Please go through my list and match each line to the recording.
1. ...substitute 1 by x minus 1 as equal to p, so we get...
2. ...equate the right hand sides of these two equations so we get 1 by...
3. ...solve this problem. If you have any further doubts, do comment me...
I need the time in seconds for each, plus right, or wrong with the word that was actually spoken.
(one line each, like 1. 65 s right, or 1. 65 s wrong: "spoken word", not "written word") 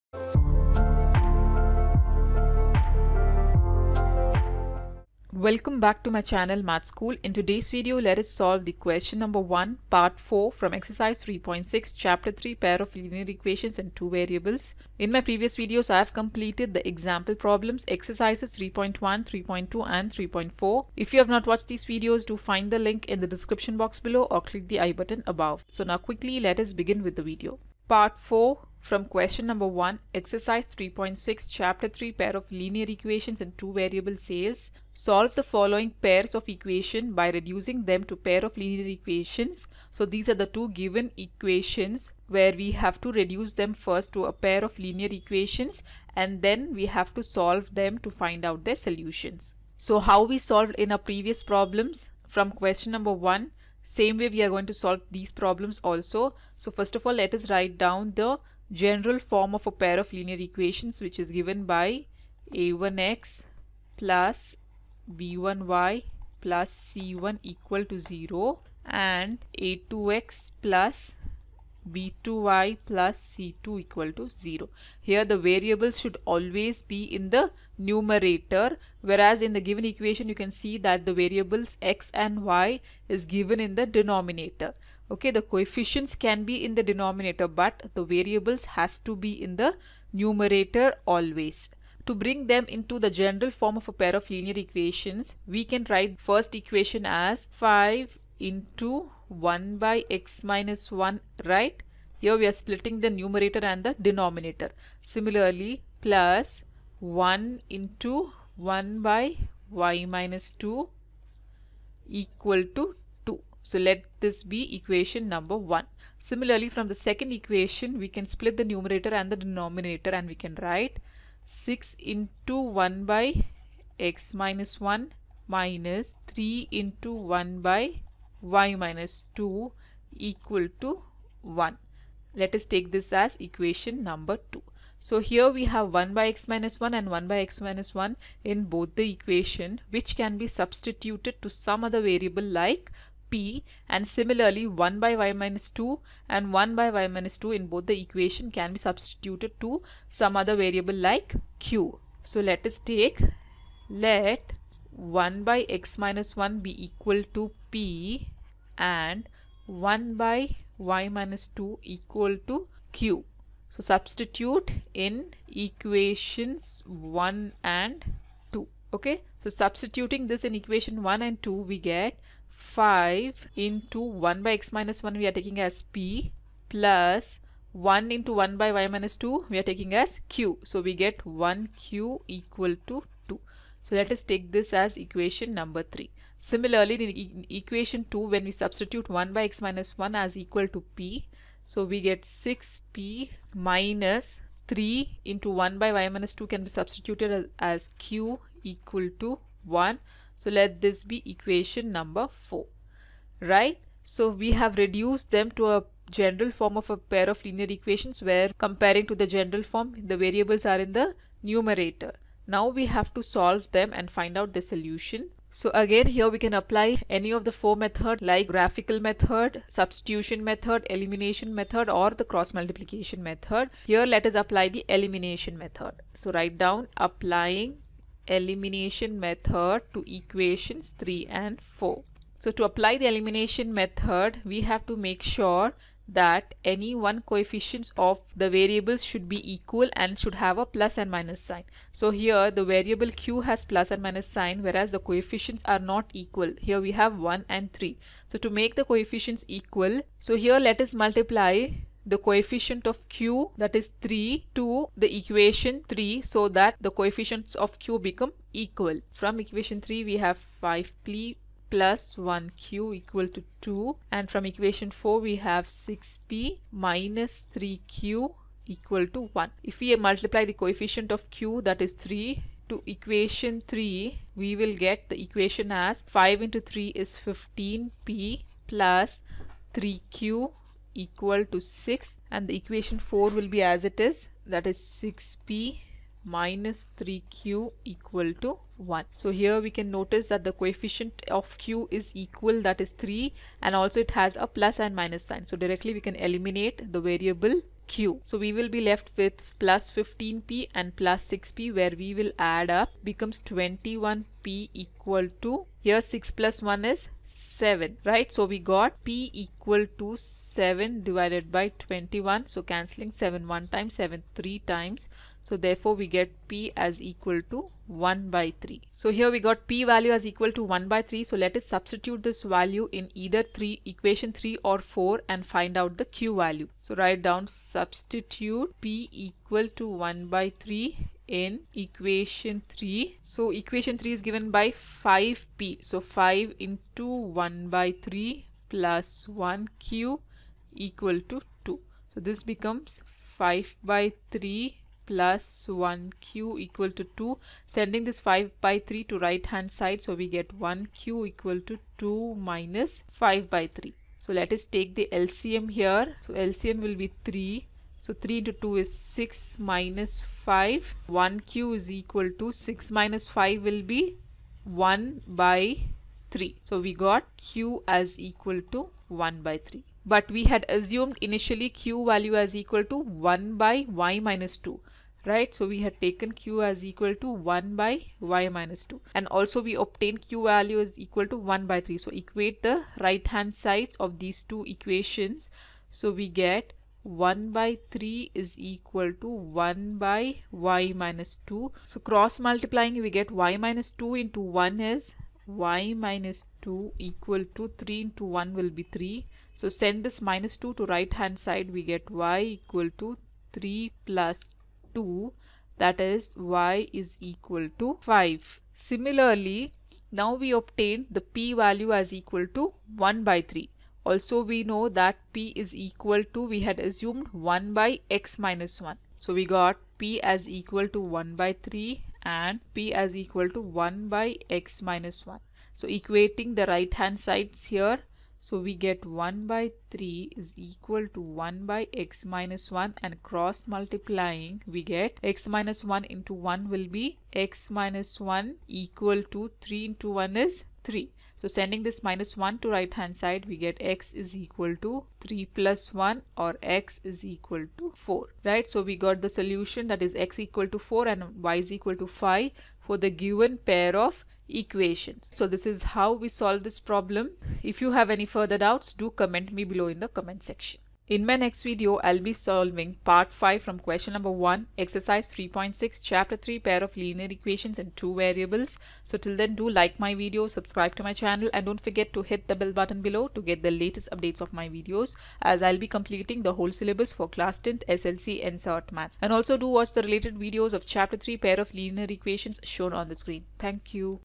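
1. 188 s right
2. 382 s right
3. 456 s right.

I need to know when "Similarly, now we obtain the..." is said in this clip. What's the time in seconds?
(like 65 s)
408 s.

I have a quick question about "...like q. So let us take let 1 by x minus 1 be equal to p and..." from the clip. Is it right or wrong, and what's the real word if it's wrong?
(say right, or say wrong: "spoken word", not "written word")
right.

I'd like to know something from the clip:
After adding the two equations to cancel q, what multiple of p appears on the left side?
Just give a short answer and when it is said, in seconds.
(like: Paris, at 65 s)
21p, at 303 s.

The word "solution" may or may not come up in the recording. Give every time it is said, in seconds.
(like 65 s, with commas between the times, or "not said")
48 s, 214 s, 449 s.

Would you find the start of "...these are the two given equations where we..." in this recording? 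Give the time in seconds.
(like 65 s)
40 s.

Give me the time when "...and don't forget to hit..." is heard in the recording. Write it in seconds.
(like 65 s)
471 s.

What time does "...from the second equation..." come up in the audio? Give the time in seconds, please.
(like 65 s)
116 s.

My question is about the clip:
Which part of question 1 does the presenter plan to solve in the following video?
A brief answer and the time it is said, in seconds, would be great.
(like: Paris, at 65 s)
Part 5, at 463 s.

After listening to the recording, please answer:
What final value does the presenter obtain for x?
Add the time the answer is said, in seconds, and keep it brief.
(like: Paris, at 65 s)
4, at 446 s.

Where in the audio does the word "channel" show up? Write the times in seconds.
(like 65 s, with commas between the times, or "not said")
6 s, 471 s.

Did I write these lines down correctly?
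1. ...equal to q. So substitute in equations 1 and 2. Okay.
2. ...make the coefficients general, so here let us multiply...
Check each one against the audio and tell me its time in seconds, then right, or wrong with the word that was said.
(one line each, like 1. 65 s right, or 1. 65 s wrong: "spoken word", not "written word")
1. 161 s right
2. 248 s wrong: "equal", not "general".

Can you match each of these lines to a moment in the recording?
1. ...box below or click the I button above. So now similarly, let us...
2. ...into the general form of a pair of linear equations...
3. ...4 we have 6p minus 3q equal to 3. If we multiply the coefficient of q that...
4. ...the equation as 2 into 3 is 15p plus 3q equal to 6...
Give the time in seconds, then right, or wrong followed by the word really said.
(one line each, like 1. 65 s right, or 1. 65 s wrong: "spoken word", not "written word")
1. 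23 s wrong: "quickly", not "similarly"
2. 92 s right
3. 264 s wrong: "1", not "3"
4. 275 s wrong: "5", not "2".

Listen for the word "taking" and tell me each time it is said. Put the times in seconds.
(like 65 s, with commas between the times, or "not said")
175 s, 179 s.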